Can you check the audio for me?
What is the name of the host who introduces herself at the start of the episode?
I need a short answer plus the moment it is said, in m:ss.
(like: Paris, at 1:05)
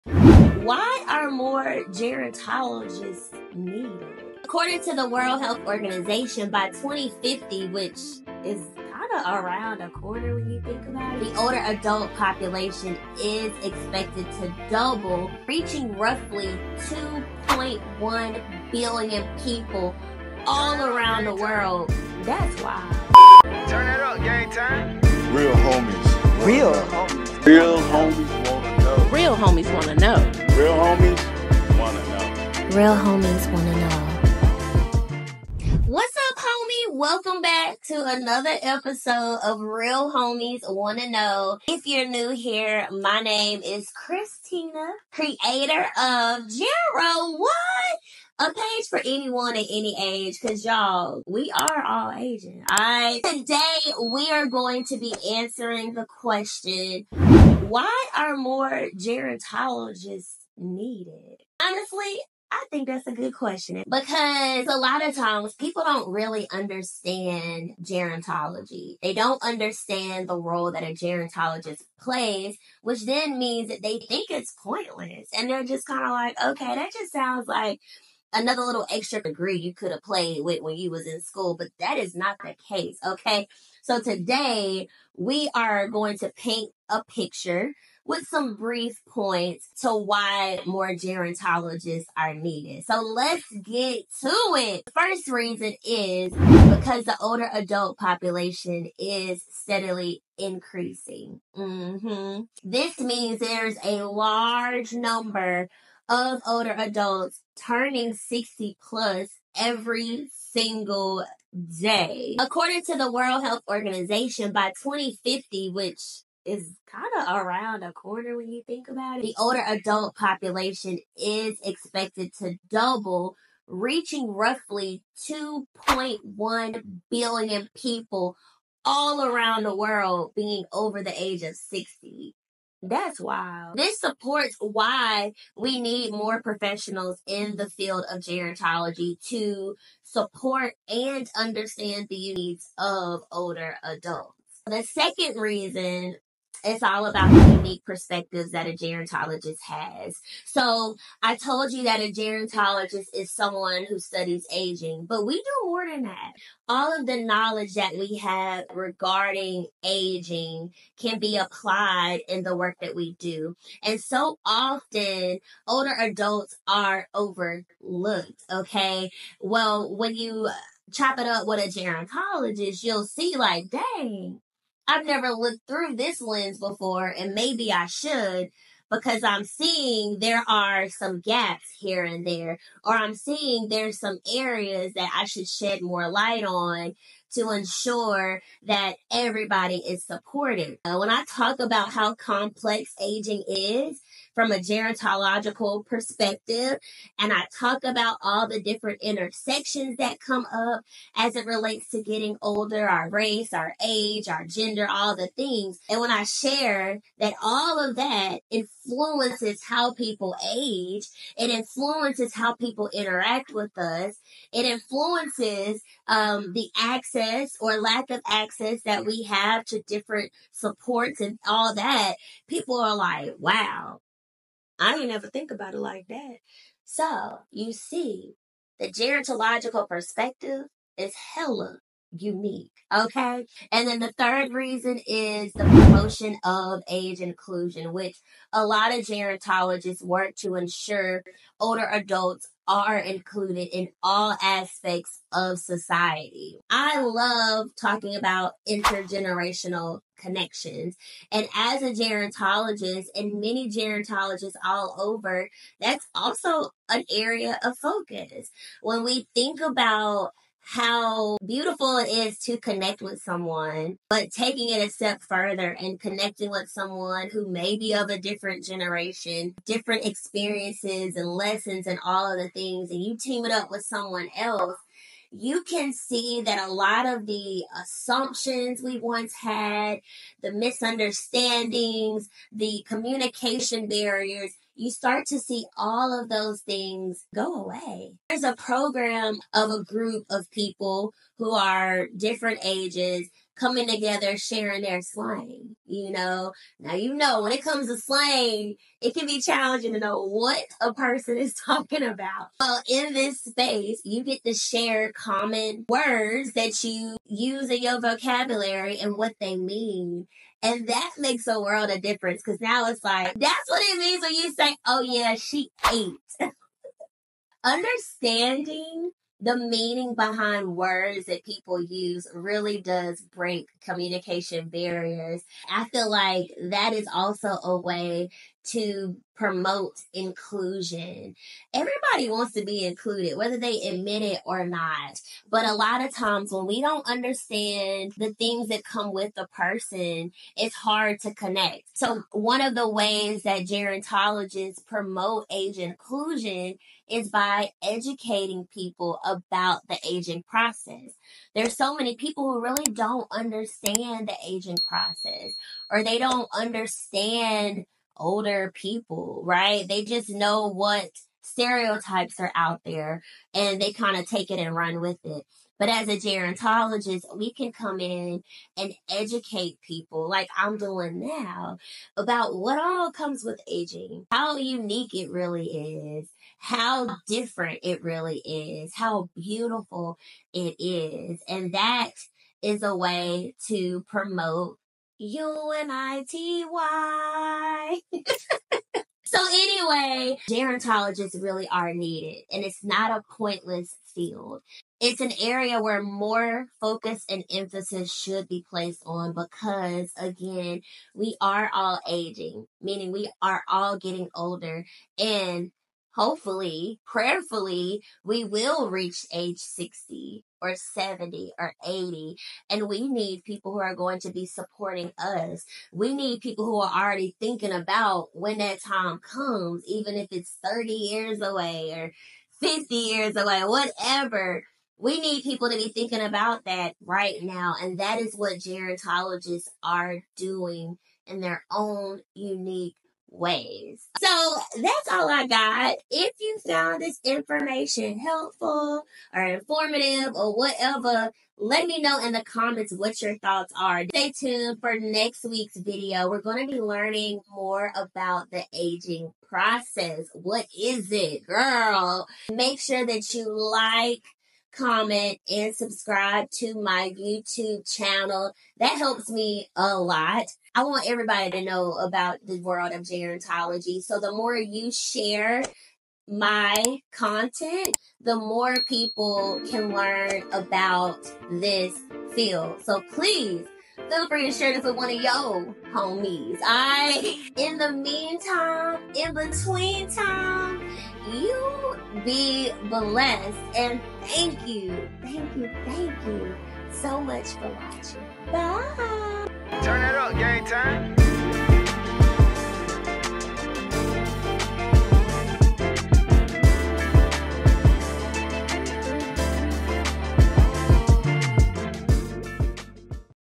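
Christina, at 0:43.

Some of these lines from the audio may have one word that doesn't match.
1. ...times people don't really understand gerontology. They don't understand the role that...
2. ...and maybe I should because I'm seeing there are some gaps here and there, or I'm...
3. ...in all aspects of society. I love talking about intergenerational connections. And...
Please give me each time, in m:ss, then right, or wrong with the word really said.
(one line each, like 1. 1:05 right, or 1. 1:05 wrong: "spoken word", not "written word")
1. 1:05 right
2. 2:57 right
3. 4:03 right.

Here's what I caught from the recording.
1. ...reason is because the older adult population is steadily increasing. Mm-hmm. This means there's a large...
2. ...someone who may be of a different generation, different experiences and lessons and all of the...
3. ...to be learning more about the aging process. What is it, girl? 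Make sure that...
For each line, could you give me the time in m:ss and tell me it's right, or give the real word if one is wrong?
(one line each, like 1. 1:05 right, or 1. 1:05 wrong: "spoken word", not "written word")
1. 1:35 right
2. 4:26 right
3. 7:26 right.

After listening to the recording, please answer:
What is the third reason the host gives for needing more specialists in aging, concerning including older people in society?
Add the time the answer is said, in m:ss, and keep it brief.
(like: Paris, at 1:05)
promotion of age inclusion, at 3:55.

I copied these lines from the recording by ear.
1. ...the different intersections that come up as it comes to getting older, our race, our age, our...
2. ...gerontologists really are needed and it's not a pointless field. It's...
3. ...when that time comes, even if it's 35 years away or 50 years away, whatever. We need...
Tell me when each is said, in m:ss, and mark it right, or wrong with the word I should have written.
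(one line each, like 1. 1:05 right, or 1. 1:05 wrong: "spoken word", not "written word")
1. 3:18 wrong: "relates", not "comes"
2. 6:30 right
3. 6:58 wrong: "30", not "35".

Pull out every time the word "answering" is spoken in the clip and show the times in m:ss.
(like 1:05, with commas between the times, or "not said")
0:55.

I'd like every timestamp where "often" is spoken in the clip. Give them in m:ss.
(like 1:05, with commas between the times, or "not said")
2:44.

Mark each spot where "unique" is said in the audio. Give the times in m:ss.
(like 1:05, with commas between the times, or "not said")
2:27, 3:52, 6:14, 7:12.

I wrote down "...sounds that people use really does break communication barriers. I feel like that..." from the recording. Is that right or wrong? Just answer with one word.
wrong.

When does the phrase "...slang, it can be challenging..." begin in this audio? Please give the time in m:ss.
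4:57.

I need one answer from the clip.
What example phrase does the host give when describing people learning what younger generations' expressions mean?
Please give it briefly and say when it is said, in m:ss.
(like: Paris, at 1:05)
she ate, at 5:15.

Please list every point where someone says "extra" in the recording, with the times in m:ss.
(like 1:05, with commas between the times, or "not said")
1:18.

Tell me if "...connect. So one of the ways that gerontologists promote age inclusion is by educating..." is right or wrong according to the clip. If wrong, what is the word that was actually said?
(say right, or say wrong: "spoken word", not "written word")
right.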